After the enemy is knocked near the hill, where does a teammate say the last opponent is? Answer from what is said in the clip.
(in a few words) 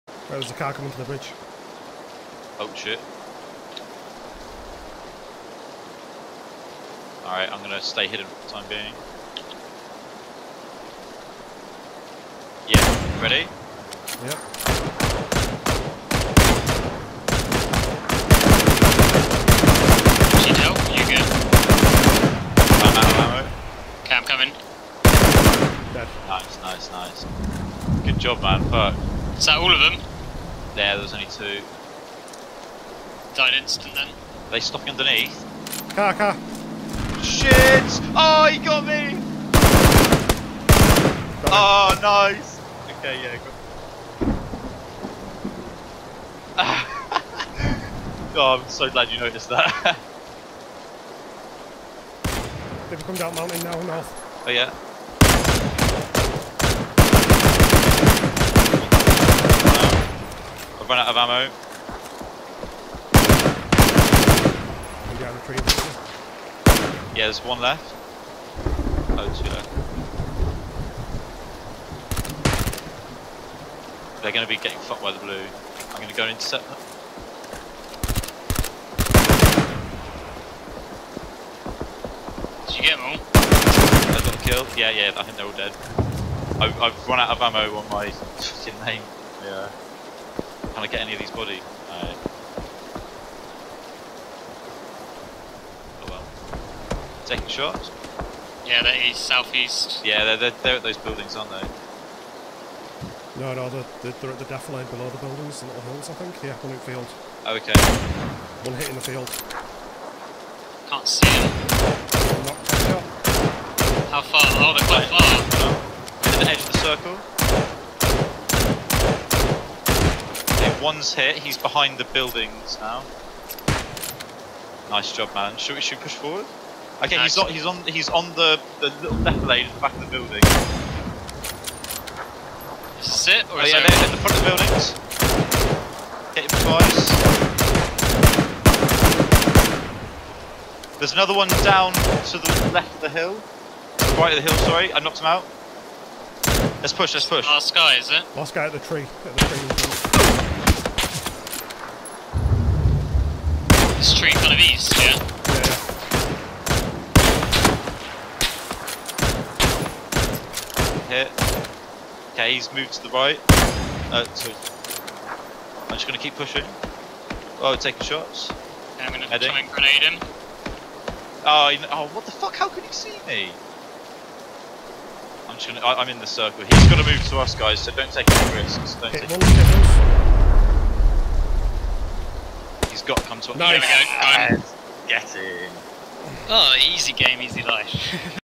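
at the tree.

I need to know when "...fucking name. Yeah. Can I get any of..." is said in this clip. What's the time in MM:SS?
01:28.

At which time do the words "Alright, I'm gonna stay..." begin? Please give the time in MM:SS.
00:07.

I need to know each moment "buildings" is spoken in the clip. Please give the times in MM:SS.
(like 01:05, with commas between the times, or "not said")
01:40, 01:45, 02:02, 02:10, 02:14.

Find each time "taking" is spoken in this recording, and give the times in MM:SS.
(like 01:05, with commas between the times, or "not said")
01:37, 02:47.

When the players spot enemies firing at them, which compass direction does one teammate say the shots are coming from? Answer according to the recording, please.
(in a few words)
southeast.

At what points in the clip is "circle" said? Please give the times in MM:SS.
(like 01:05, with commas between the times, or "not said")
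01:56, 02:56.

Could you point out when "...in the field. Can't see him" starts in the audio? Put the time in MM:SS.
01:48.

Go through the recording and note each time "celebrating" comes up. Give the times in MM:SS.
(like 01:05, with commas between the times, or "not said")
not said.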